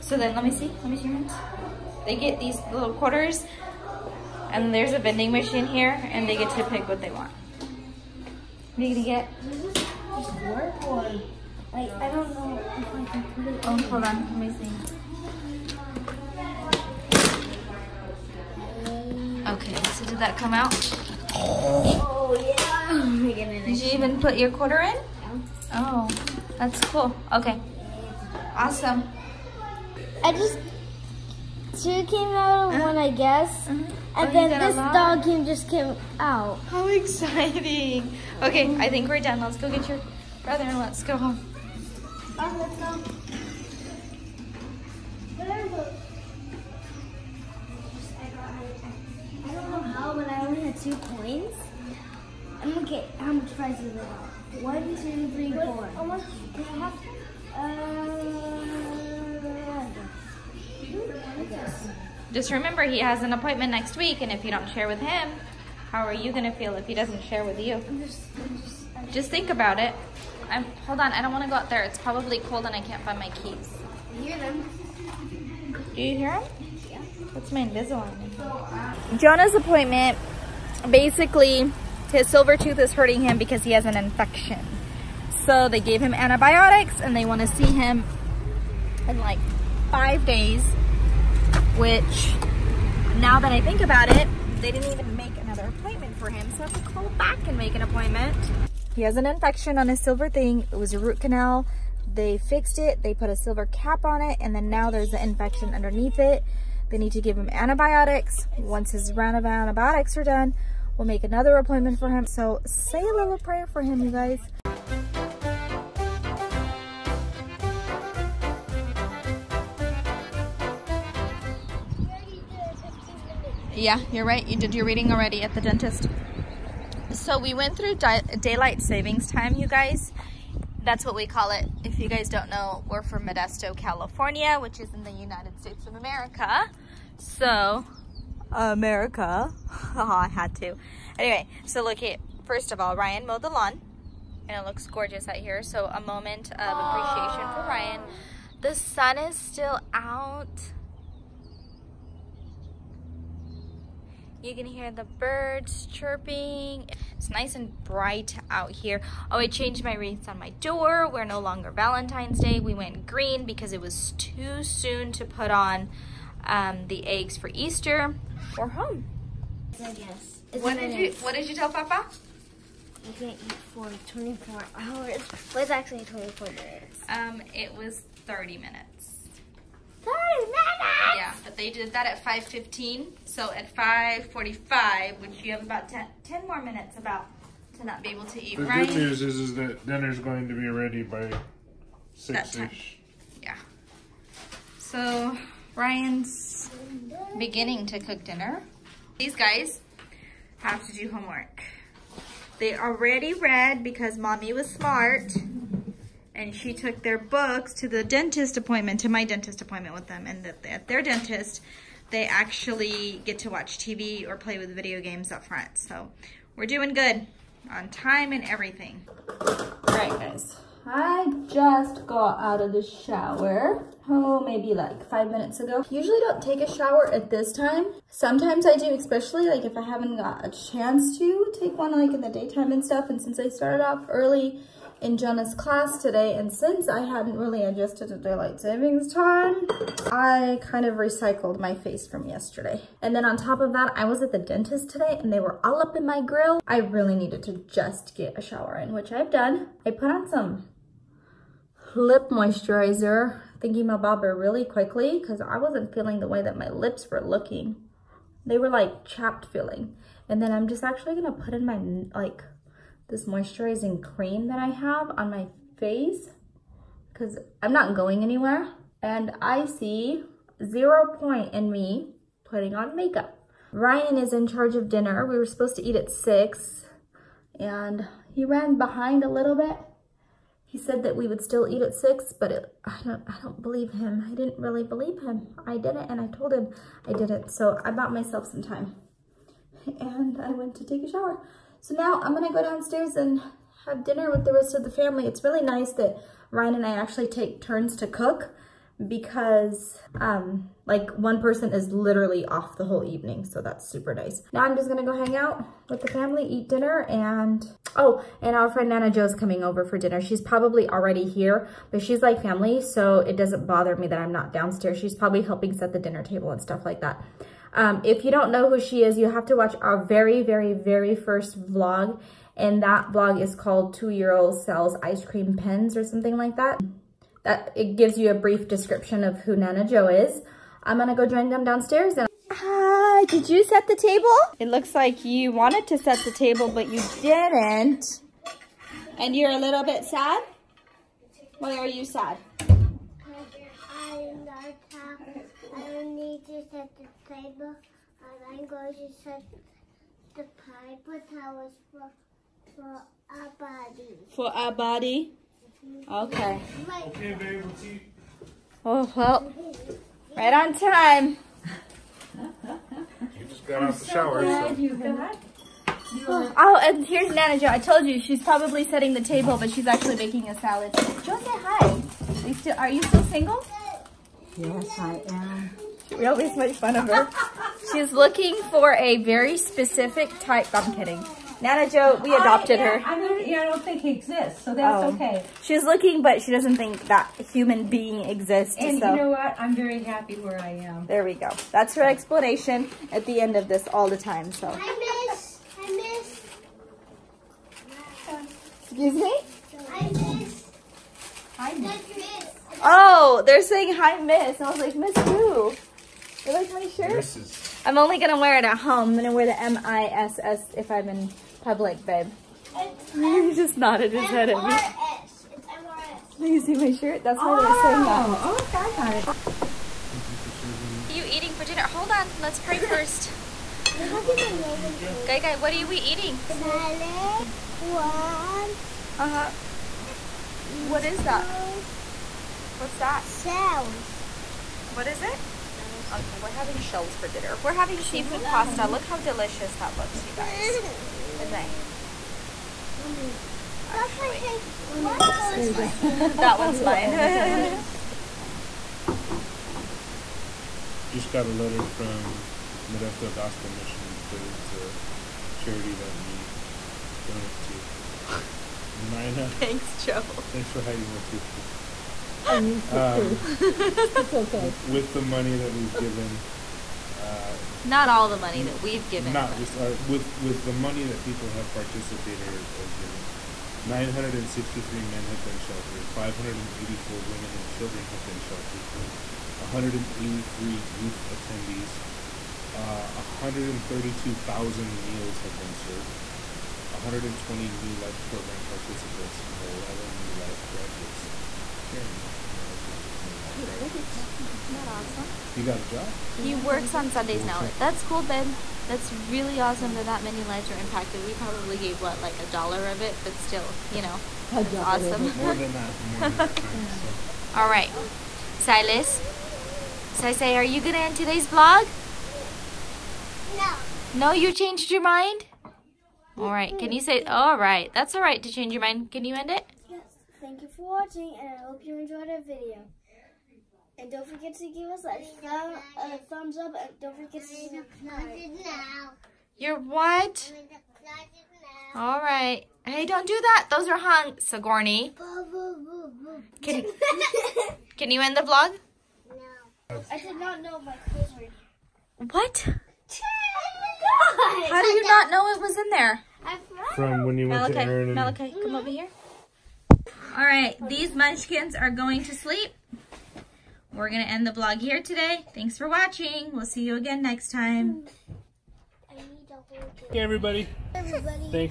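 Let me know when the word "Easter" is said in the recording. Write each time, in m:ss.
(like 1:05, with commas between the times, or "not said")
2:47.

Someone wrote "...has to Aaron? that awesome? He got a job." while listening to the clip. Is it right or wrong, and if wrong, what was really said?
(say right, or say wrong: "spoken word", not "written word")
wrong: "Jeremy", not "Aaron".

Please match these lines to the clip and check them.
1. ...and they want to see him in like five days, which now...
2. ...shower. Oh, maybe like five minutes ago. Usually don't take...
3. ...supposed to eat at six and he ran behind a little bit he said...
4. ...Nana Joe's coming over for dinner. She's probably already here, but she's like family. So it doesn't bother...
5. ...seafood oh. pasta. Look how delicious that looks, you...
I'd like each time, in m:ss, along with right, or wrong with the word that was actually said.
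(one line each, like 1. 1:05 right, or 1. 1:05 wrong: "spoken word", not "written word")
1. 1:27 right
2. 3:42 right
3. 4:35 right
4. 5:08 right
5. 7:17 right.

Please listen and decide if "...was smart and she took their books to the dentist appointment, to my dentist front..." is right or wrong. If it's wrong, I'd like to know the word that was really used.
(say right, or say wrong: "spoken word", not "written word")
wrong: "appointment", not "front".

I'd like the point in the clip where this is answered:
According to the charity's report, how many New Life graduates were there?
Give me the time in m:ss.
8:09.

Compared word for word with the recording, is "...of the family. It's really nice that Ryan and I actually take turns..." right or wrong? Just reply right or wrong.
right.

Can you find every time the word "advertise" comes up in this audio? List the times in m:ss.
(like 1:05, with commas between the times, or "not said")
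not said.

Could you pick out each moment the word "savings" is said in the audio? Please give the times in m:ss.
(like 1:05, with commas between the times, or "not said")
2:08, 3:58.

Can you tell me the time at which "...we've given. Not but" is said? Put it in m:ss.
7:48.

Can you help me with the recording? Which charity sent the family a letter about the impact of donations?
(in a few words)
Modesto Gospel Mission.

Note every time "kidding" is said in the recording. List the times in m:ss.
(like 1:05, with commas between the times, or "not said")
6:20.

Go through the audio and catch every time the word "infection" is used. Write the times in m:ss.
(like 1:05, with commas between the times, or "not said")
1:23, 1:39, 1:45.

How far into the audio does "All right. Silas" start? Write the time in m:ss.
8:27.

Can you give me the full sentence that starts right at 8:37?
That's all right to change your mind.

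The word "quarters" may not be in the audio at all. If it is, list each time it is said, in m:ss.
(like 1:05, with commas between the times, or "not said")
0:02, 0:24.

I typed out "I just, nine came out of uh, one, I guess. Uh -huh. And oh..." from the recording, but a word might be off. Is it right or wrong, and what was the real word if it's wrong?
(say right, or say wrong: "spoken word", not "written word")
wrong: "two", not "nine".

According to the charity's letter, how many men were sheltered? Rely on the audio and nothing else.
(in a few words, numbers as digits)
963.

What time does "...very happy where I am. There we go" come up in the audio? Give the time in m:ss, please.
6:29.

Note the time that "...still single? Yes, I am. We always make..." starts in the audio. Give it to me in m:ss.
6:13.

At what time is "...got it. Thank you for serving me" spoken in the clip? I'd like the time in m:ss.
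6:59.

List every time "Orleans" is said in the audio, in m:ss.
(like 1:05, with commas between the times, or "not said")
not said.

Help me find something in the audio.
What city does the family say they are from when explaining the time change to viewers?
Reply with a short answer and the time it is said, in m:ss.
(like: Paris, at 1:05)
Modesto, California, at 2:13.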